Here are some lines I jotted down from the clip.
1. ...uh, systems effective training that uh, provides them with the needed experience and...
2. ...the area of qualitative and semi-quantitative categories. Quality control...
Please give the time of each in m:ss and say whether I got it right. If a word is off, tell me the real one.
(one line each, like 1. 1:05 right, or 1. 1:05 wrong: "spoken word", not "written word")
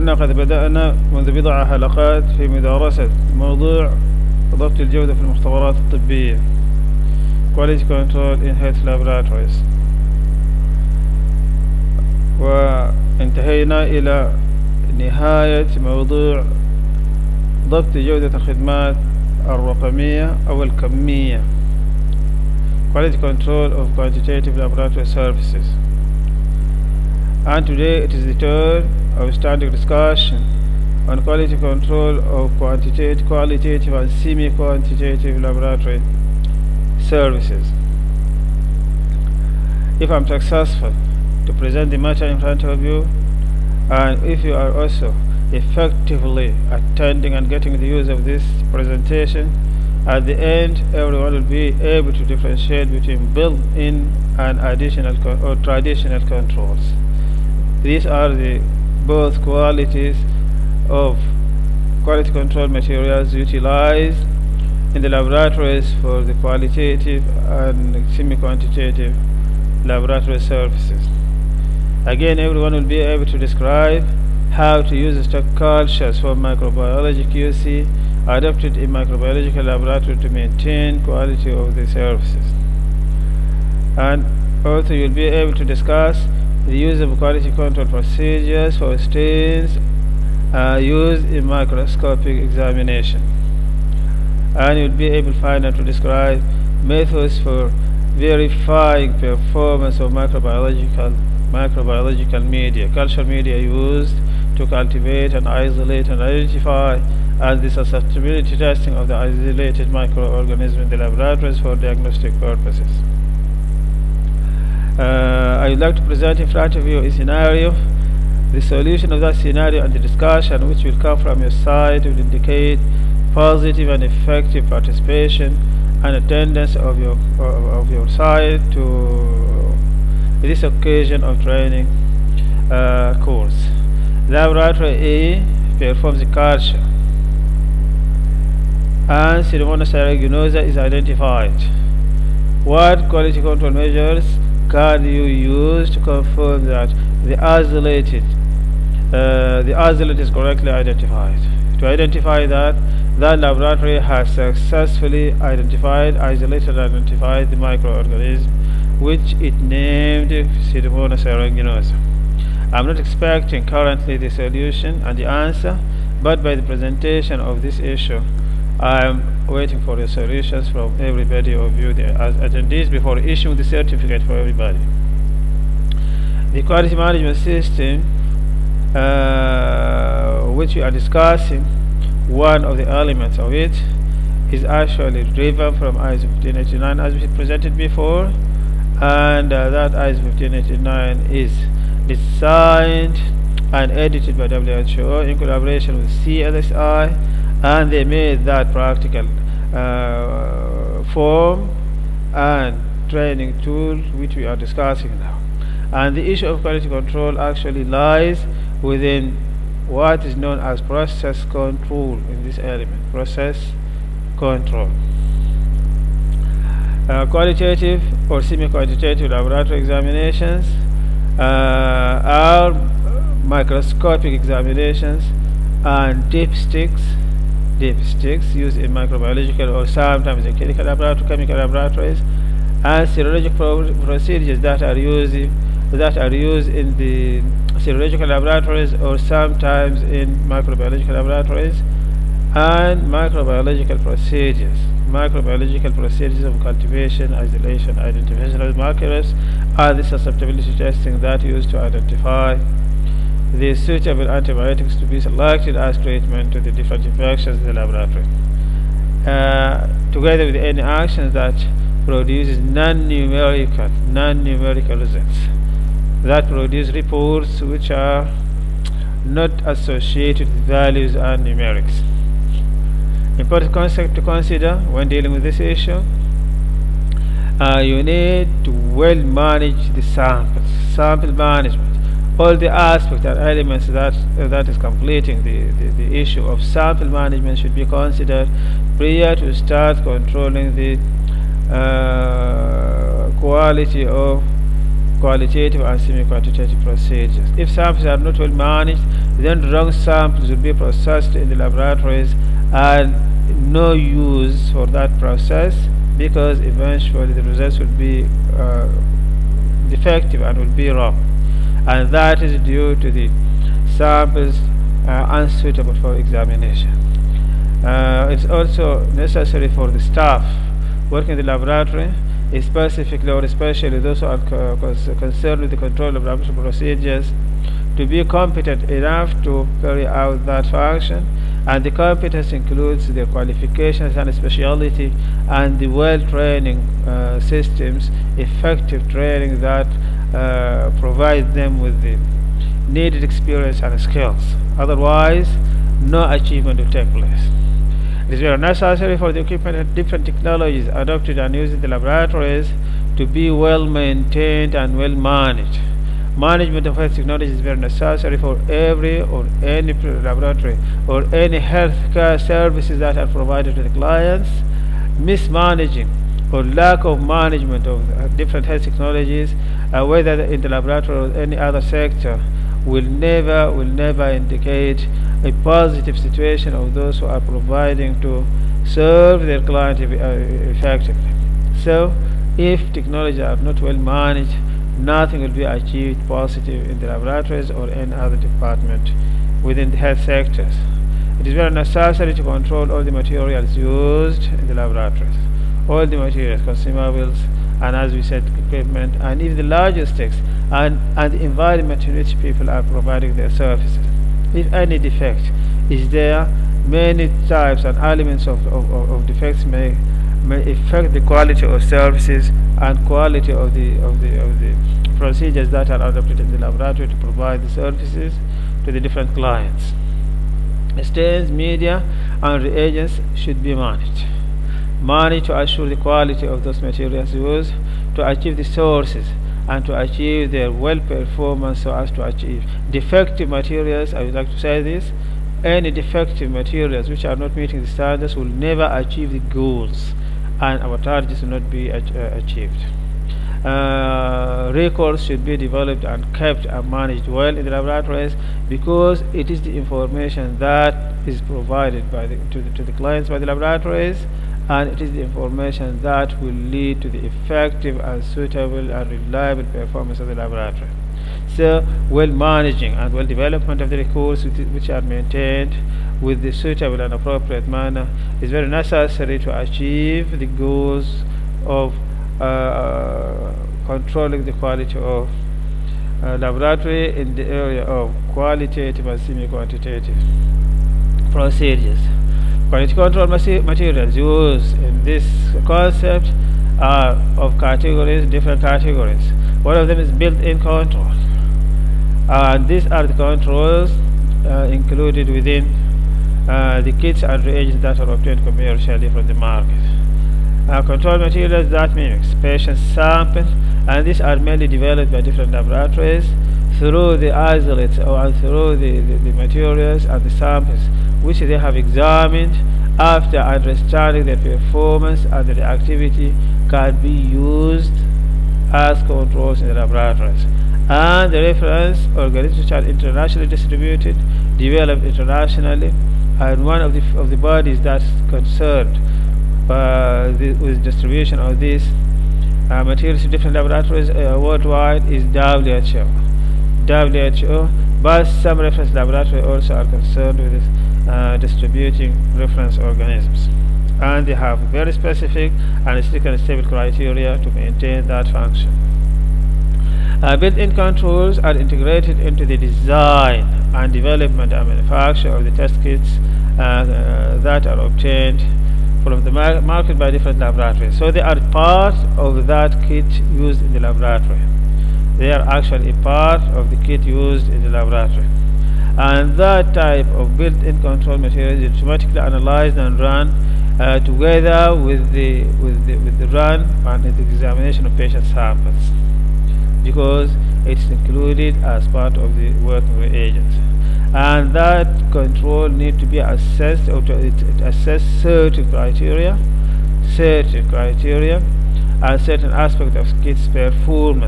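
1. 5:37 right
2. 7:57 wrong: "procedures", not "categories".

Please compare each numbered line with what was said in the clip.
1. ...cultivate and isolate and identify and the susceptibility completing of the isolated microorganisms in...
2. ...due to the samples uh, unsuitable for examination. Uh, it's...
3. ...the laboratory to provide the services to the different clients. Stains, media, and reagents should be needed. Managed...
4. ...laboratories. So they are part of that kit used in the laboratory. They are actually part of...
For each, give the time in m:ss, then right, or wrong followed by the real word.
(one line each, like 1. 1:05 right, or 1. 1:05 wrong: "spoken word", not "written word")
1. 1:44 wrong: "testing", not "completing"
2. 5:12 right
3. 6:56 wrong: "managed", not "needed"
4. 9:20 right.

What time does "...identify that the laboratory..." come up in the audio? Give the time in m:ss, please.
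2:31.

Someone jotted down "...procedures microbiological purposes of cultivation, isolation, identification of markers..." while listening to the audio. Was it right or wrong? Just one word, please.
wrong.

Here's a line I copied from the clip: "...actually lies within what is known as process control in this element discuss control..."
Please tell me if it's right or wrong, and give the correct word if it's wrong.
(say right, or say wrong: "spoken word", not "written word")
wrong: "process", not "discuss".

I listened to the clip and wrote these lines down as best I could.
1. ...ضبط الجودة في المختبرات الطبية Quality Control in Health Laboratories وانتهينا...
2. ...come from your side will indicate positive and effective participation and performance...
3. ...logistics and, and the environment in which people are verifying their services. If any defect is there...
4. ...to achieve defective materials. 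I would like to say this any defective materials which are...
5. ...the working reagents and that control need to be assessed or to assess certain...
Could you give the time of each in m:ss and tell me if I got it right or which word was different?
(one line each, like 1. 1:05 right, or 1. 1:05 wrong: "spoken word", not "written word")
1. 0:04 right
2. 2:00 wrong: "attendance", not "performance"
3. 6:39 wrong: "providing", not "verifying"
4. 7:12 right
5. 9:42 right.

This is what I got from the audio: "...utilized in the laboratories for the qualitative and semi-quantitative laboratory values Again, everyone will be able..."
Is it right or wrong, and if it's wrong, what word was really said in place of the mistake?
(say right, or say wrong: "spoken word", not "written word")
wrong: "services", not "values".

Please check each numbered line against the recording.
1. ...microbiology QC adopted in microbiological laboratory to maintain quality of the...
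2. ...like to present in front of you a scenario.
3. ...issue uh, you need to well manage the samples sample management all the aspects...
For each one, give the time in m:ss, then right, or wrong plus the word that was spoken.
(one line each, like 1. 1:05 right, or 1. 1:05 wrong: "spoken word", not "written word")
1. 1:16 right
2. 1:55 right
3. 4:35 right.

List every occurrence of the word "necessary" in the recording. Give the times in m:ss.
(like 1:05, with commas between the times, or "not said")
5:19, 5:48, 5:57, 6:31, 7:48.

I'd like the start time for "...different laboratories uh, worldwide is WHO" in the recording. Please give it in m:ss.
8:53.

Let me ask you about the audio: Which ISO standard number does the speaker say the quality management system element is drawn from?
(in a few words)
1589.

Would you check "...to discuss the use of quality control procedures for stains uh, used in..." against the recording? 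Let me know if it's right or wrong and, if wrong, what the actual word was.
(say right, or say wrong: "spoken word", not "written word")
right.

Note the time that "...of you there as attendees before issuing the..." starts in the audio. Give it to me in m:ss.
2:51.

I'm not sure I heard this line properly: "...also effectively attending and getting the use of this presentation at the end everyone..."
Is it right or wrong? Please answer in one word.
right.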